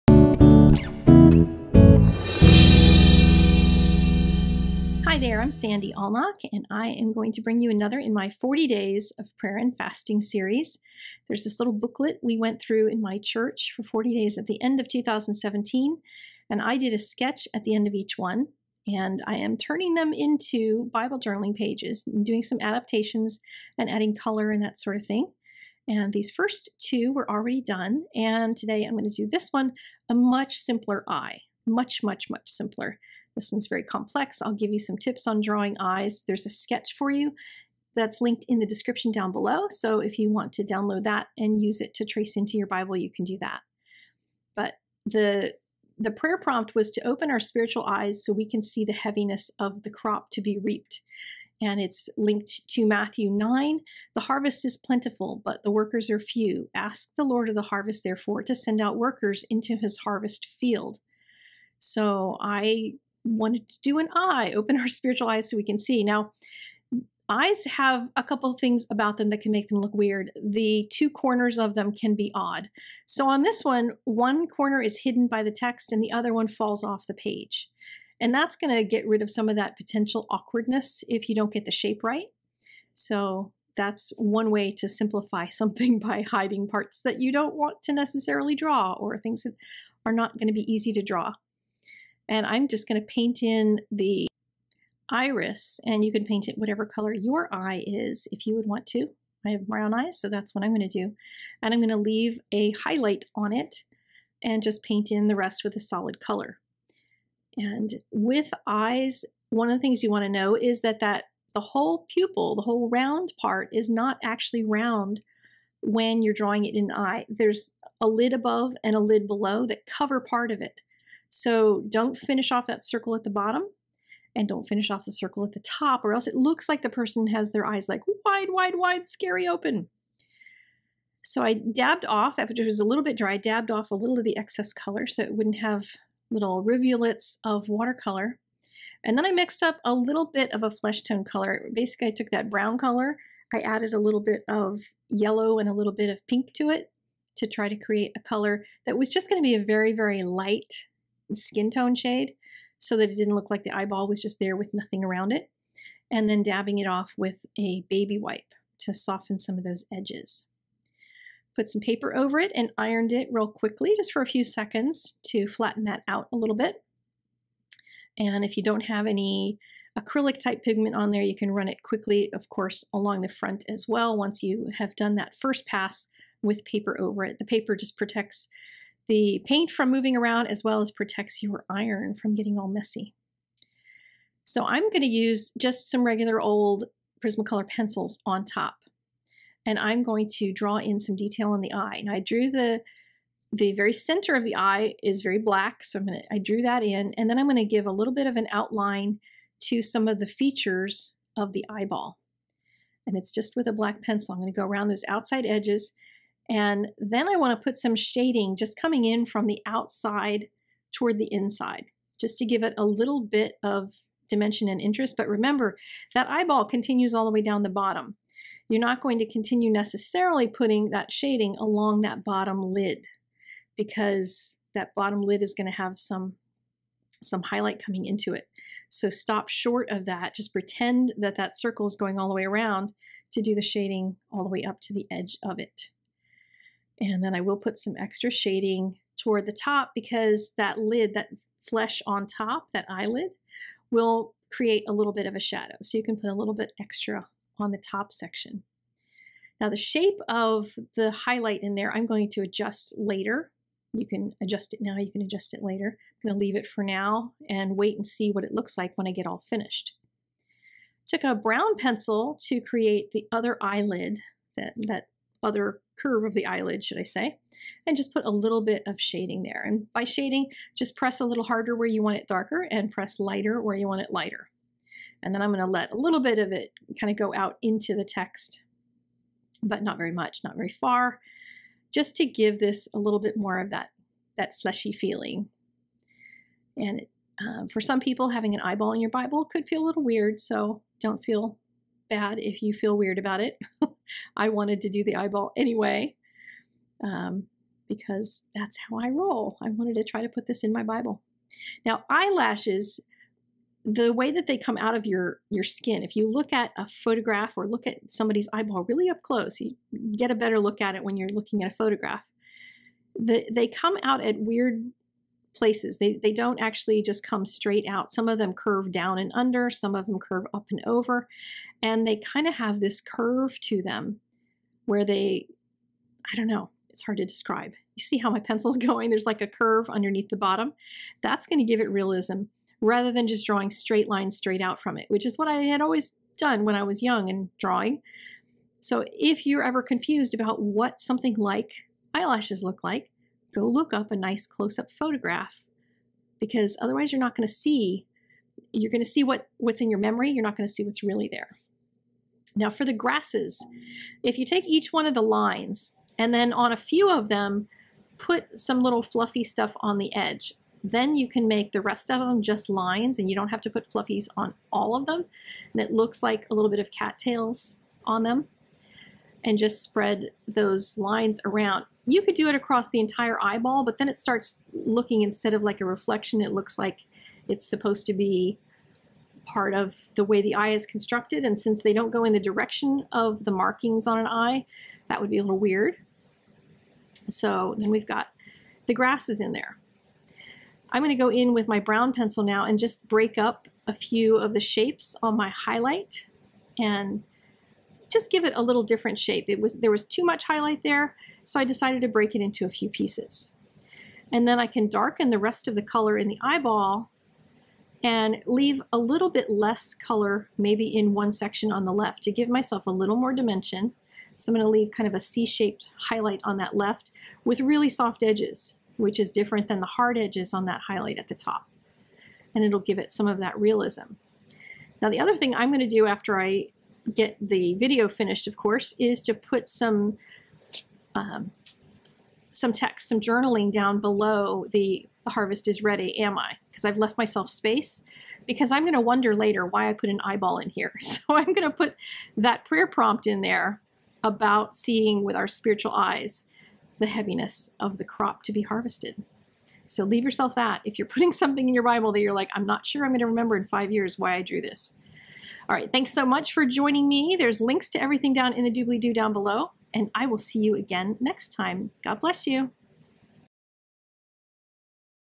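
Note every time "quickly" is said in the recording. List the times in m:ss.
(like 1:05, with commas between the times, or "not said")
2:43, 2:51.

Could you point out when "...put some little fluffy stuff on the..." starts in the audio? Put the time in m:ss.
5:58.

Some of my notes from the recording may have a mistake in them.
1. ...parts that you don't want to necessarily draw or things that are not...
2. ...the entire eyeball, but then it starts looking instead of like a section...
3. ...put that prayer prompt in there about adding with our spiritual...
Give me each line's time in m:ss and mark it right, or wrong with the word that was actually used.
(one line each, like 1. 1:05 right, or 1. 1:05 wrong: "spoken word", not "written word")
1. 1:26 right
2. 6:12 wrong: "reflection", not "section"
3. 7:21 wrong: "seeing", not "adding".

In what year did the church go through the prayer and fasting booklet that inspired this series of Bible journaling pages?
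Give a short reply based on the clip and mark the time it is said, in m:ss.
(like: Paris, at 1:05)
2017, at 0:14.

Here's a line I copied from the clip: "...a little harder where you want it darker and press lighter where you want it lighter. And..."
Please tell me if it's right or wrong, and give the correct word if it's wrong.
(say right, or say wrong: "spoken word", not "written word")
right.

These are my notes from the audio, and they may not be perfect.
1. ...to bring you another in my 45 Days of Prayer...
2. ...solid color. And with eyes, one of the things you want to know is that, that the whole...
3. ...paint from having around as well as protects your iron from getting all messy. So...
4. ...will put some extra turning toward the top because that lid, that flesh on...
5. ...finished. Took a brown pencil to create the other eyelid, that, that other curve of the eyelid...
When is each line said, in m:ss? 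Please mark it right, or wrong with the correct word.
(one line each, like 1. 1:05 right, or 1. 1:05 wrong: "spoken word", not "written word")
1. 0:07 wrong: "40", not "45"
2. 1:45 right
3. 2:59 wrong: "moving", not "having"
4. 3:57 wrong: "shading", not "turning"
5. 4:19 right.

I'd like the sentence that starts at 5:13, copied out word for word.
The, they come out at weird places.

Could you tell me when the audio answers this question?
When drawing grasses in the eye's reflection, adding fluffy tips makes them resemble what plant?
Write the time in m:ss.
6:06.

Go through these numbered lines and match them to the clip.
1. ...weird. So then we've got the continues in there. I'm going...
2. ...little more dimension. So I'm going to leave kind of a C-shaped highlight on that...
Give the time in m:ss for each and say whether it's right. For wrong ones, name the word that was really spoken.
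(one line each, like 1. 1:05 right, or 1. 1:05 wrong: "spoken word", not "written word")
1. 6:25 wrong: "grasses", not "continues"
2. 6:52 right.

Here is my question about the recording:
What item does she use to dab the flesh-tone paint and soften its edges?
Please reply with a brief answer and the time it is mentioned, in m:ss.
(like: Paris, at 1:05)
A baby wipe, at 2:37.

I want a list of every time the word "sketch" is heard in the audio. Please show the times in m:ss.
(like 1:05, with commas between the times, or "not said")
0:16, 0:36.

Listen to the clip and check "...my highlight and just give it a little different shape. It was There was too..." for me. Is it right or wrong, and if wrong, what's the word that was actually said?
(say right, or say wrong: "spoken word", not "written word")
right.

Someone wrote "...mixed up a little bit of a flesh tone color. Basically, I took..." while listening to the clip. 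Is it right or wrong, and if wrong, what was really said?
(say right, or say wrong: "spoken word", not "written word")
right.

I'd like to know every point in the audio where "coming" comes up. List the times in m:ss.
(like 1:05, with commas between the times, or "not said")
3:28, 3:47.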